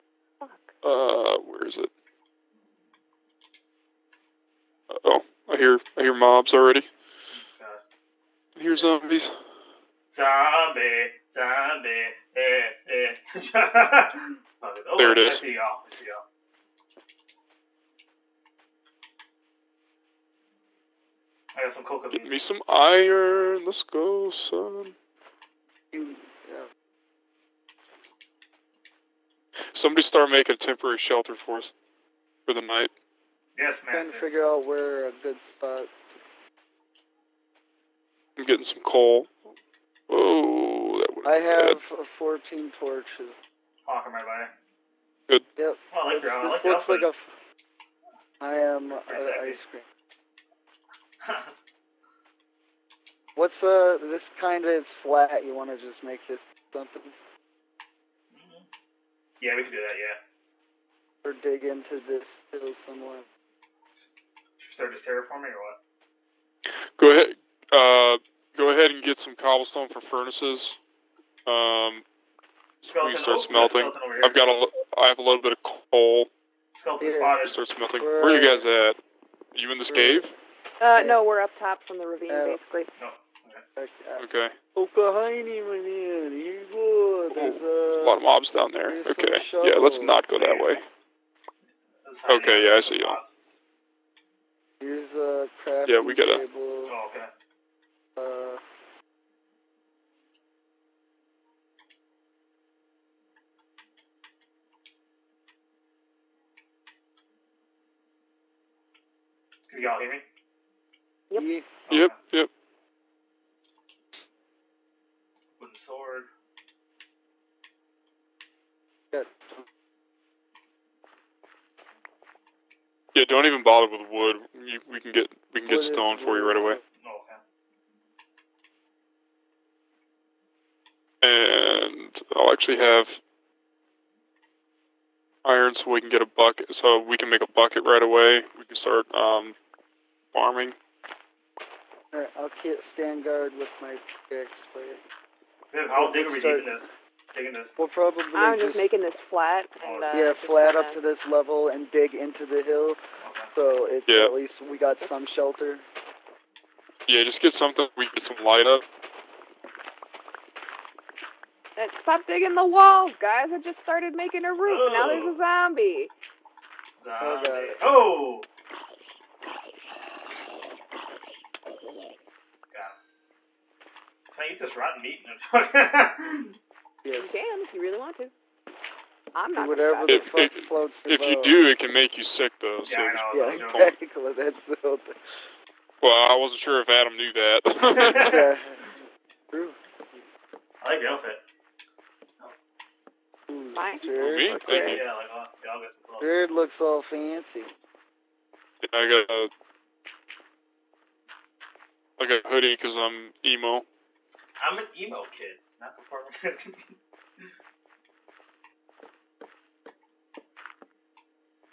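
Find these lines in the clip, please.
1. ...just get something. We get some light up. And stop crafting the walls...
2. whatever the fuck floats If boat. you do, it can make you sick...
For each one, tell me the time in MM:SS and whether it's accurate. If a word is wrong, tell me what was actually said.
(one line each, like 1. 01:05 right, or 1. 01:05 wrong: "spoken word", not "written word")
1. 02:37 wrong: "digging", not "crafting"
2. 02:59 right.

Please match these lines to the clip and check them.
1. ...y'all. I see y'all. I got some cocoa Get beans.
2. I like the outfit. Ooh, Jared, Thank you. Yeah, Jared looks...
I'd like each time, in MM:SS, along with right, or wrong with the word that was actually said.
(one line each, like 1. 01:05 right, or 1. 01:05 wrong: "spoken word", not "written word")
1. 00:15 right
2. 03:10 right.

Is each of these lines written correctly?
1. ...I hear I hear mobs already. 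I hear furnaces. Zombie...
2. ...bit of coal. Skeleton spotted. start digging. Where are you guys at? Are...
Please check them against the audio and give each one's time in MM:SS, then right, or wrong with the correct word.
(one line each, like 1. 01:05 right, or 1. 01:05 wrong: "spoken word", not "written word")
1. 00:05 wrong: "zombies", not "furnaces"
2. 01:15 wrong: "smelting", not "digging".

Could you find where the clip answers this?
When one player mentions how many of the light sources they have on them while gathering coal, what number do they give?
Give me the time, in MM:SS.
00:42.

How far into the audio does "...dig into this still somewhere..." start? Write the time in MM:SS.
01:01.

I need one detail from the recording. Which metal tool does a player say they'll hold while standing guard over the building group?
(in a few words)
pickaxe.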